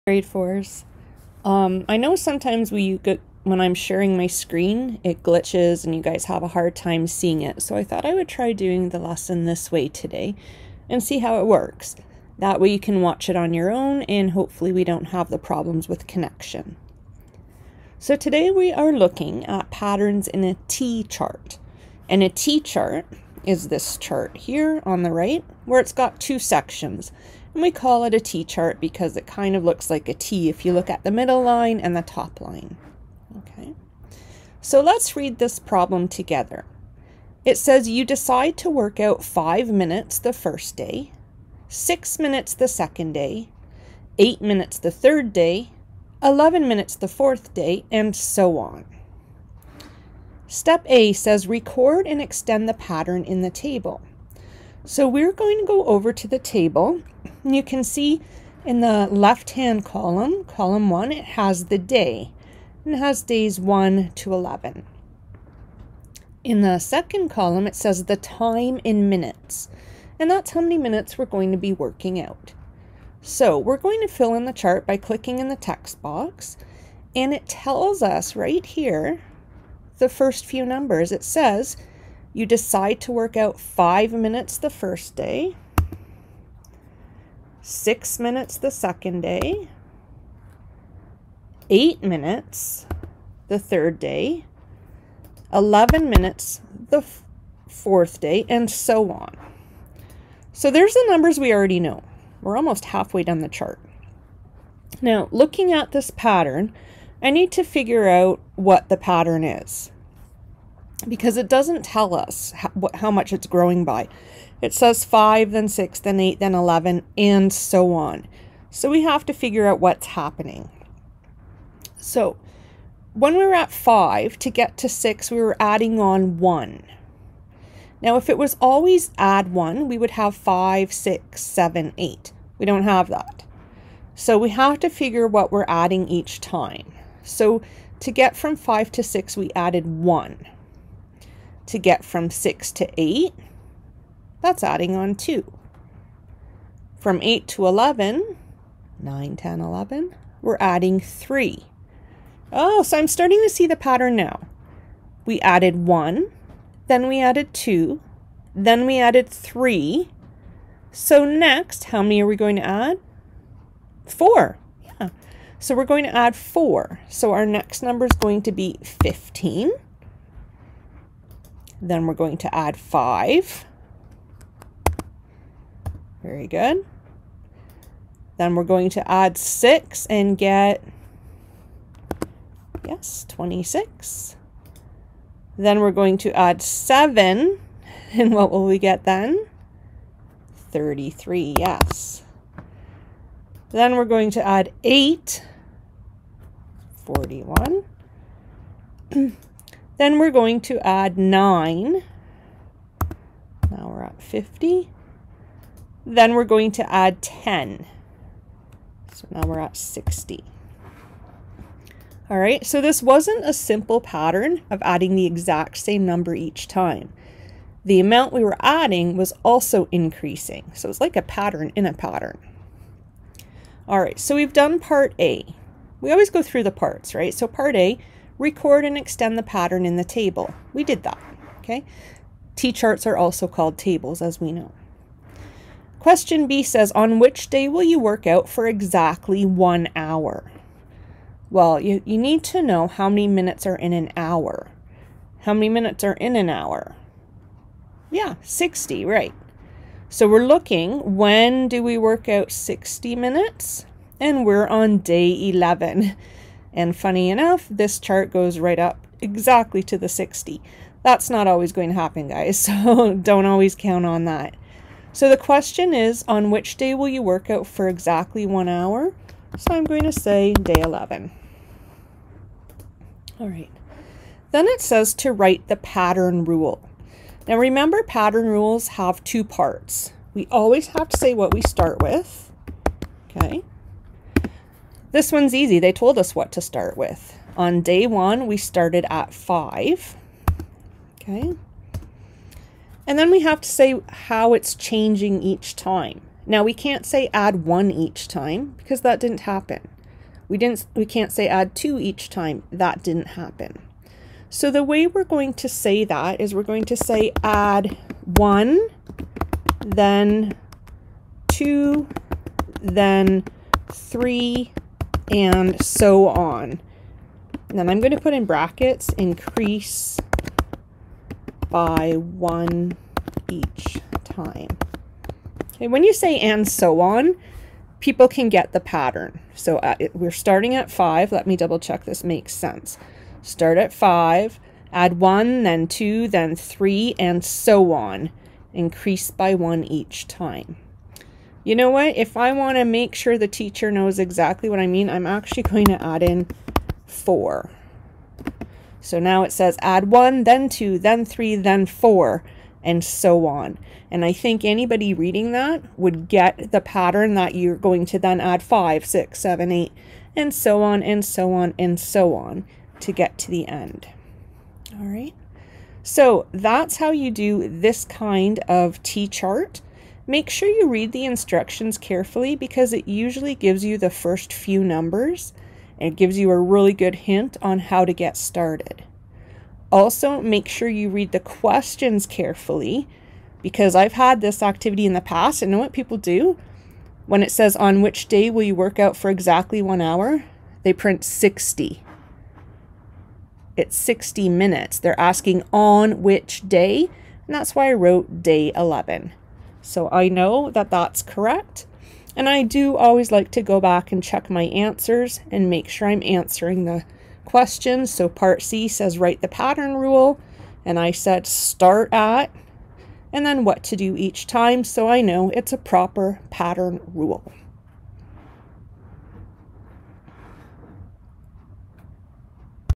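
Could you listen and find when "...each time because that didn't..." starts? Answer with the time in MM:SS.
04:57.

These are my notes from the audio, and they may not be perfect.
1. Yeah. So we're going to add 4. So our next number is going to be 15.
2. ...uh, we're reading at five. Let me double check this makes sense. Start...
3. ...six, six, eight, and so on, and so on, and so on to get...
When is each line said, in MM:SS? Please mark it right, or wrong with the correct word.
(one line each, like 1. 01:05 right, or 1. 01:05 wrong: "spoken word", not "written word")
1. 02:44 right
2. 05:29 wrong: "starting", not "reading"
3. 05:59 wrong: "seven", not "six".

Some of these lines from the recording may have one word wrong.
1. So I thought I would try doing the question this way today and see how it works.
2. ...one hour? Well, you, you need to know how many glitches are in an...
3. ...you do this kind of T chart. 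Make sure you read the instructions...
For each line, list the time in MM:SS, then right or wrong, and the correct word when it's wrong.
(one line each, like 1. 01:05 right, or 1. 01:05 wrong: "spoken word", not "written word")
1. 00:07 wrong: "lesson", not "question"
2. 03:59 wrong: "minutes", not "glitches"
3. 06:07 right.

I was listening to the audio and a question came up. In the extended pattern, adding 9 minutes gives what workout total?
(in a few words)
50.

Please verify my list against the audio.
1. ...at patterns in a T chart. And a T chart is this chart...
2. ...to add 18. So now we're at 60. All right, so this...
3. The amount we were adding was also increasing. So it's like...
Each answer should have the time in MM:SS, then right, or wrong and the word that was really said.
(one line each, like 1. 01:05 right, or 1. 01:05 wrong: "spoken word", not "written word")
1. 00:19 right
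2. 03:26 wrong: "10", not "18"
3. 03:37 right.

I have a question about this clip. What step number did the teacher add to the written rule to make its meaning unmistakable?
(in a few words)
4.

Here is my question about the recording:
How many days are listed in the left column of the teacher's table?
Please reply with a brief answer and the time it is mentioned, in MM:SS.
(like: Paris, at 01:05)
11, at 01:02.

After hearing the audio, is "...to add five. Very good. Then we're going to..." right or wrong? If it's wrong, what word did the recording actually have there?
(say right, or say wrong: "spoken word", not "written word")
right.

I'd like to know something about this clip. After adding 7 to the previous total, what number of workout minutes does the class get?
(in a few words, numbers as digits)
33.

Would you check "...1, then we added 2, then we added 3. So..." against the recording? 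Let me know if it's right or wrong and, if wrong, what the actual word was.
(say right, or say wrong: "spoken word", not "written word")
right.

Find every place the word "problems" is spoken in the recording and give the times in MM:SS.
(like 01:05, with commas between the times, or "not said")
00:15, 00:35.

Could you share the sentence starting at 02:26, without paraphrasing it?
From 8 to 11, 9, 10, 11, we're adding 3.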